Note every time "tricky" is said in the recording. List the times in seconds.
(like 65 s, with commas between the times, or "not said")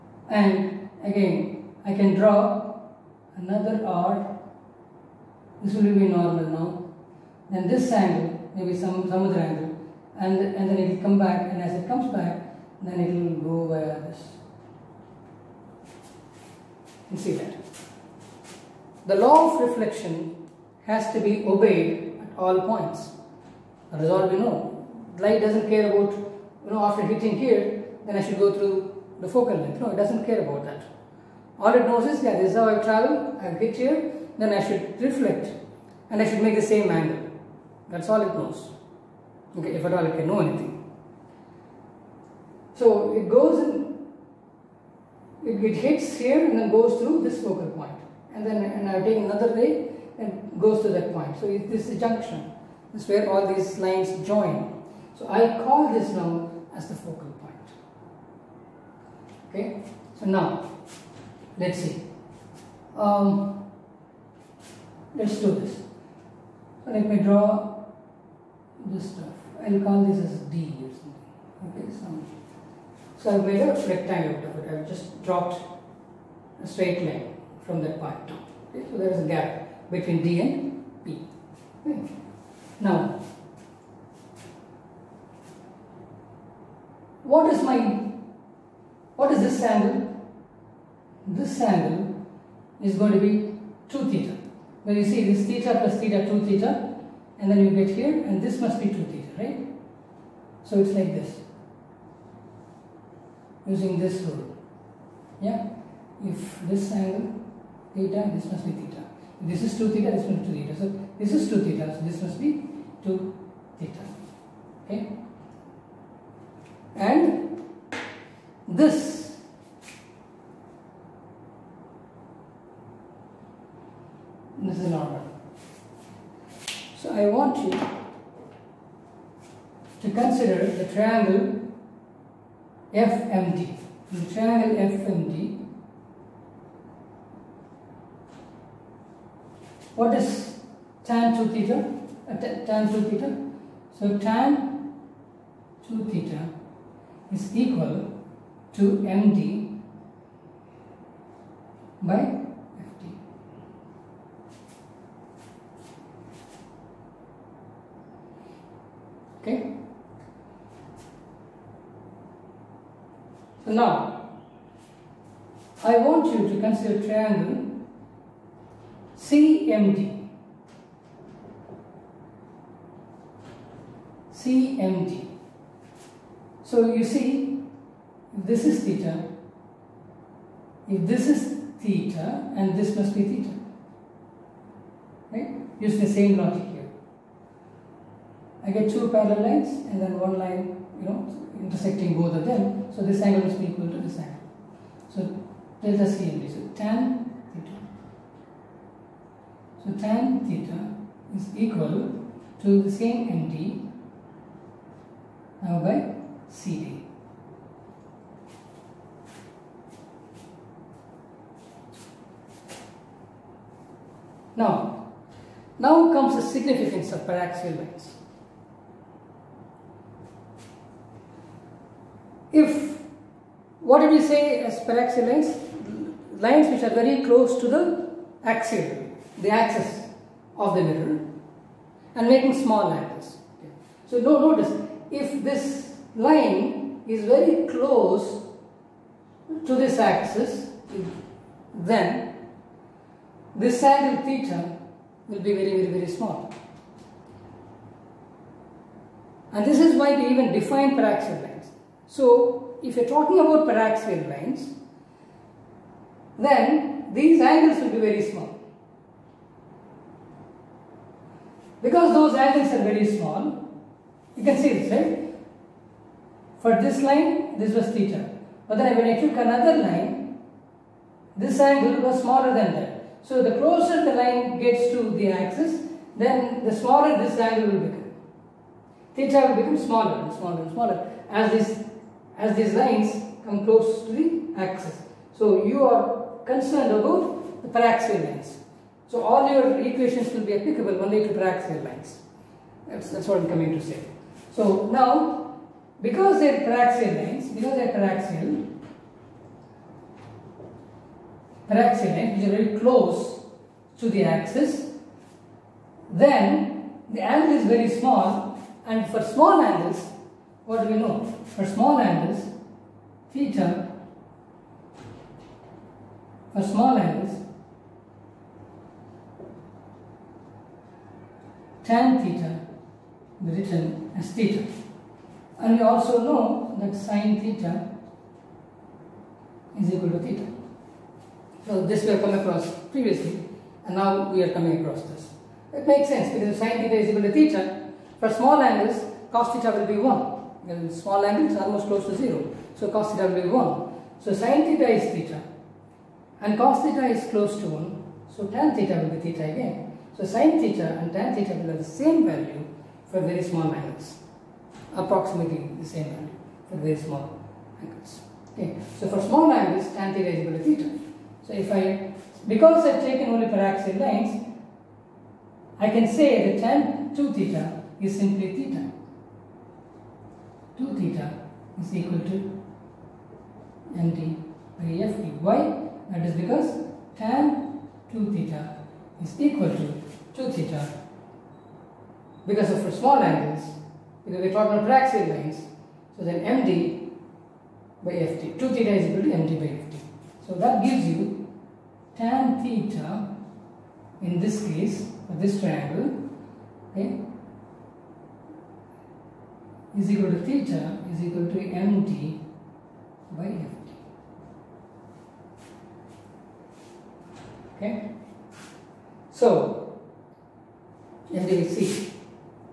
not said.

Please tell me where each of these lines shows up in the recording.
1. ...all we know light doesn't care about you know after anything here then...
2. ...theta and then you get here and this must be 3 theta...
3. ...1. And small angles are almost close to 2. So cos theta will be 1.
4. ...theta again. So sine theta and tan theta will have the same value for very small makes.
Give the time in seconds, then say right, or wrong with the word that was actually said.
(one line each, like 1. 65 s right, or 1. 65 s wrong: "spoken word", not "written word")
1. 24 s wrong: "hitting", not "anything"
2. 96 s wrong: "2", not "3"
3. 339 s wrong: "0", not "2"
4. 349 s wrong: "angles", not "makes".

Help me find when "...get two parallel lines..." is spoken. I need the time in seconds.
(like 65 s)
188 s.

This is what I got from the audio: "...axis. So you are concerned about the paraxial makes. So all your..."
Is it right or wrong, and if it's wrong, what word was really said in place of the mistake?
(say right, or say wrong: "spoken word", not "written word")
wrong: "lines", not "makes".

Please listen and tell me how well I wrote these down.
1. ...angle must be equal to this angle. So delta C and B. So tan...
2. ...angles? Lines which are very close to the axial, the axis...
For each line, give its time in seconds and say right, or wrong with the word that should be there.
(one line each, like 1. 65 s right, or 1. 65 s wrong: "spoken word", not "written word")
1. 193 s right
2. 225 s wrong: "lines", not "angles".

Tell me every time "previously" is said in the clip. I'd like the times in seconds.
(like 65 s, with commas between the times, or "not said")
332 s.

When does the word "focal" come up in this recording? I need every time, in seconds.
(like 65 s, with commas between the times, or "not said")
29 s, 47 s, 56 s.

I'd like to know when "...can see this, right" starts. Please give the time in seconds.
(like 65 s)
264 s.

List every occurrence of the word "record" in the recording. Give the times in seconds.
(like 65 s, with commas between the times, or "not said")
not said.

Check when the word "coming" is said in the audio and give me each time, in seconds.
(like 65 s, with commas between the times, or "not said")
293 s, 334 s.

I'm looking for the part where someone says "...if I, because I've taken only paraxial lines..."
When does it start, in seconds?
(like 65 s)
361 s.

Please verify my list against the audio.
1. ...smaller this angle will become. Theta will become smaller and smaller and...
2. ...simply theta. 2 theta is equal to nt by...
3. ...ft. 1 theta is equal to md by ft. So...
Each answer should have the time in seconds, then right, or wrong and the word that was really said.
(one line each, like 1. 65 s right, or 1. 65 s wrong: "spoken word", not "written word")
1. 276 s right
2. 368 s right
3. 388 s wrong: "2", not "1".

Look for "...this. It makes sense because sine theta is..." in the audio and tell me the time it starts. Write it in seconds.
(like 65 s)
335 s.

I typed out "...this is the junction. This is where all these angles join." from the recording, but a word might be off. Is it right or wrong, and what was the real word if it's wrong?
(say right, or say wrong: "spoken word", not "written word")
wrong: "lines", not "angles".